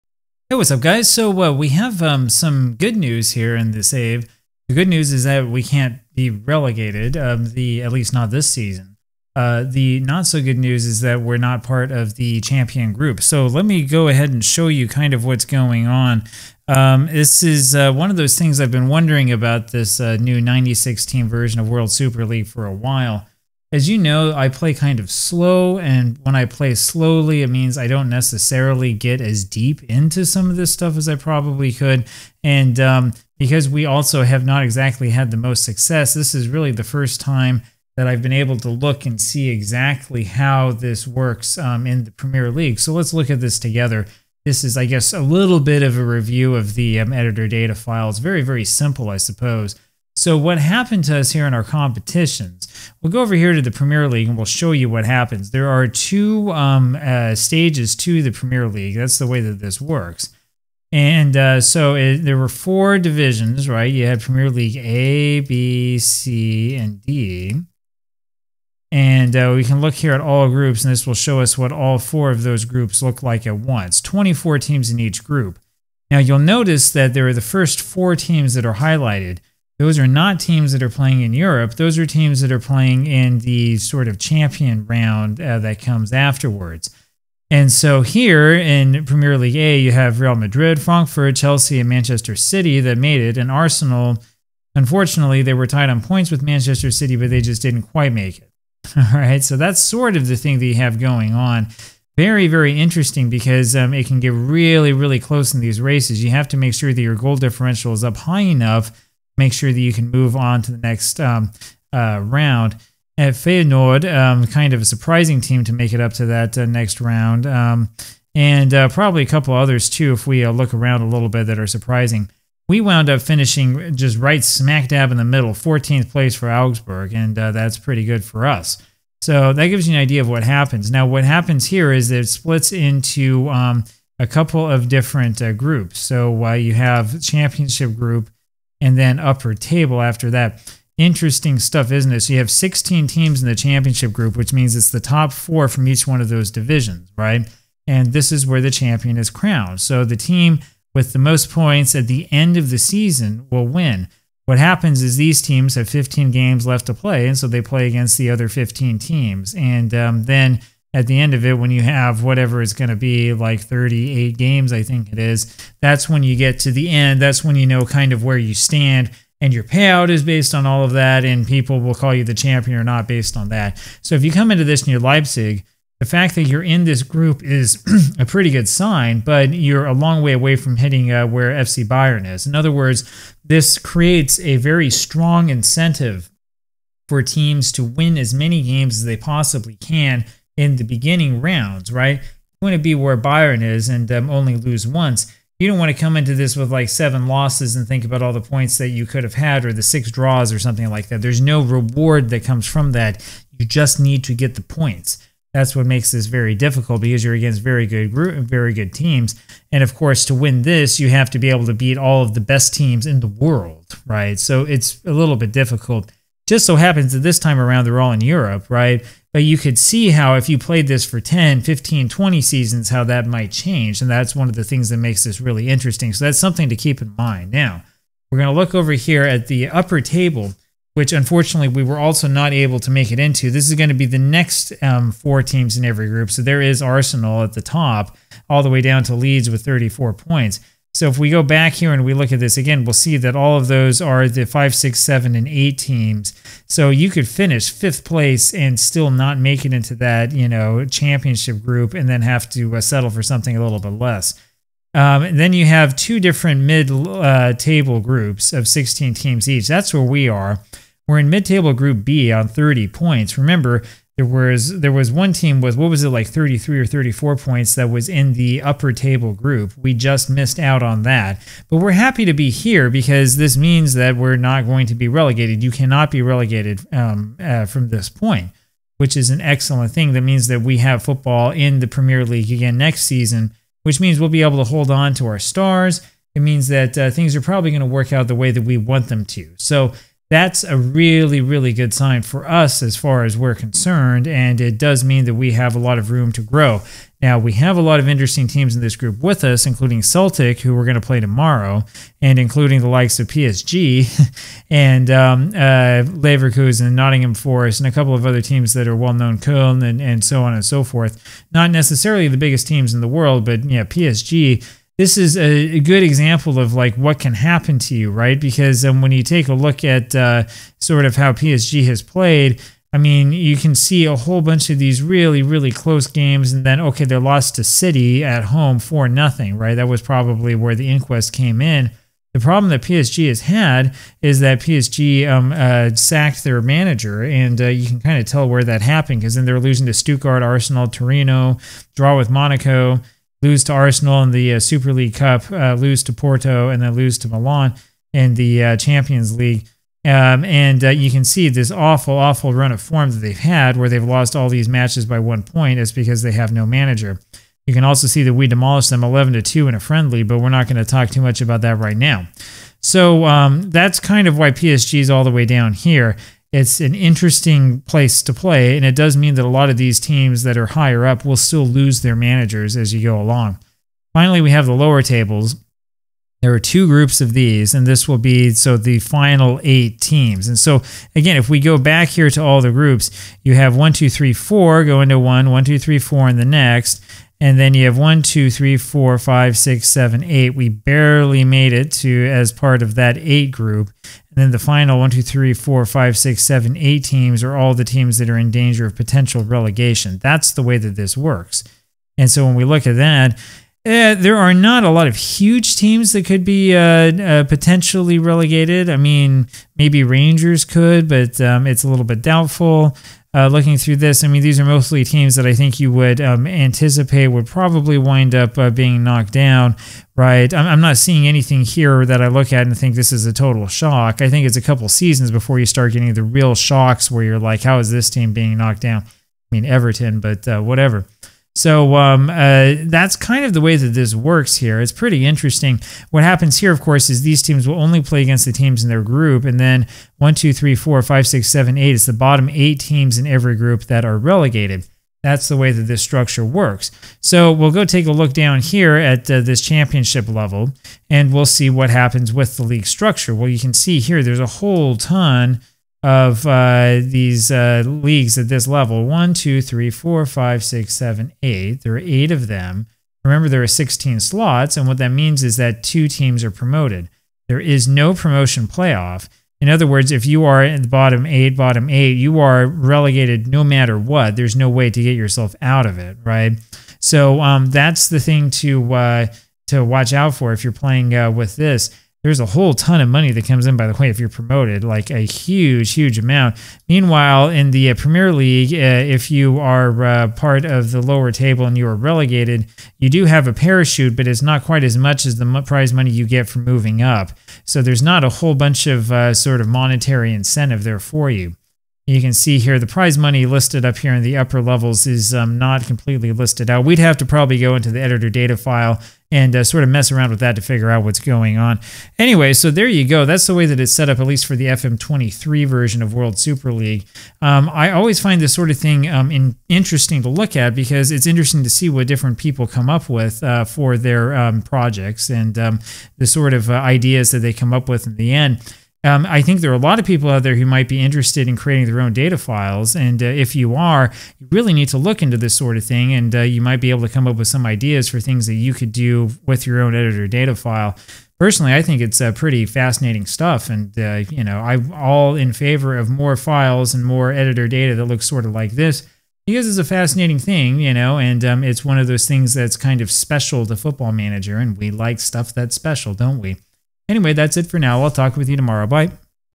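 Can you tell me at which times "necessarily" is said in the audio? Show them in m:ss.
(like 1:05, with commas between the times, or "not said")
0:28, 5:11.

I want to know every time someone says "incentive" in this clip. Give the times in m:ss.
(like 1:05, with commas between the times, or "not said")
3:05, 8:20.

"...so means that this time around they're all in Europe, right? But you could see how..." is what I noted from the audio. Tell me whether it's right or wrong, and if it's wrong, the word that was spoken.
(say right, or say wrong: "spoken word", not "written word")
wrong: "happens", not "means".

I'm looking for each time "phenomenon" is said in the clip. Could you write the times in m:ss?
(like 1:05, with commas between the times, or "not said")
not said.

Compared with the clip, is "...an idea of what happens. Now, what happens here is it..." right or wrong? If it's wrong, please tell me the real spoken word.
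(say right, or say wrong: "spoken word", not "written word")
right.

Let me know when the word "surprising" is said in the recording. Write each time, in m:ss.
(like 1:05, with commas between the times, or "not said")
1:54, 2:01.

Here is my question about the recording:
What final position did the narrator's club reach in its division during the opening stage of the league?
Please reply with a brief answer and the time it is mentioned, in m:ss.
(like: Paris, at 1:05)
14th place, at 2:05.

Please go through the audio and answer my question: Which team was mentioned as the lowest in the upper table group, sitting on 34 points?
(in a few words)
Leeds.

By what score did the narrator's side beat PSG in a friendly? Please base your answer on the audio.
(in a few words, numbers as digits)
11 to 2.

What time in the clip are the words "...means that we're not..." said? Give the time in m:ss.
4:33.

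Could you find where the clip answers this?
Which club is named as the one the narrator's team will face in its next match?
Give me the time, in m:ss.
5:00.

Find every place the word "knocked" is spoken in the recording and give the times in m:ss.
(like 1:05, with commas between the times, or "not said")
6:59, 7:08.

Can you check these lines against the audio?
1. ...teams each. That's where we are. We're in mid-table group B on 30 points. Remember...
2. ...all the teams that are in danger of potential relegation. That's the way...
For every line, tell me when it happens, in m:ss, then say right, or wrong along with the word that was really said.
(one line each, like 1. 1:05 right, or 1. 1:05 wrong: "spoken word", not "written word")
1. 4:19 right
2. 6:37 right.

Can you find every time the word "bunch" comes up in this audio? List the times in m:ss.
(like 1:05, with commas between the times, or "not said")
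5:24, 8:18.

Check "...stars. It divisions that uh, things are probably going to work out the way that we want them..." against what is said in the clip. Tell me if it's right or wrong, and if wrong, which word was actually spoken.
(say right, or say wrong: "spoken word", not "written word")
wrong: "means", not "divisions".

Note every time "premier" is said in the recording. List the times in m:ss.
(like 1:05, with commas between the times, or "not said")
0:42, 0:53, 0:58, 1:04, 1:29, 4:41, 8:07.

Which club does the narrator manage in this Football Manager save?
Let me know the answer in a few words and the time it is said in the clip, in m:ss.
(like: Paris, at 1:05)
Augsburg, at 2:06.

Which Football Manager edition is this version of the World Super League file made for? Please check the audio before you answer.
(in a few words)
FM23.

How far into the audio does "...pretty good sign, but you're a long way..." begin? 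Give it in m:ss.
2:58.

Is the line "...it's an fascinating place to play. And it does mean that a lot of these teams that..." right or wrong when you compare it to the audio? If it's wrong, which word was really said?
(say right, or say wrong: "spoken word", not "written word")
wrong: "interesting", not "fascinating".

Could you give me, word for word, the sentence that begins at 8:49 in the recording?
Um, I think there are a lot of people out there who might be interested in creating their own data files.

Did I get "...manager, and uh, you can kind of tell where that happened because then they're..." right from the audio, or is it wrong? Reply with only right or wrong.
right.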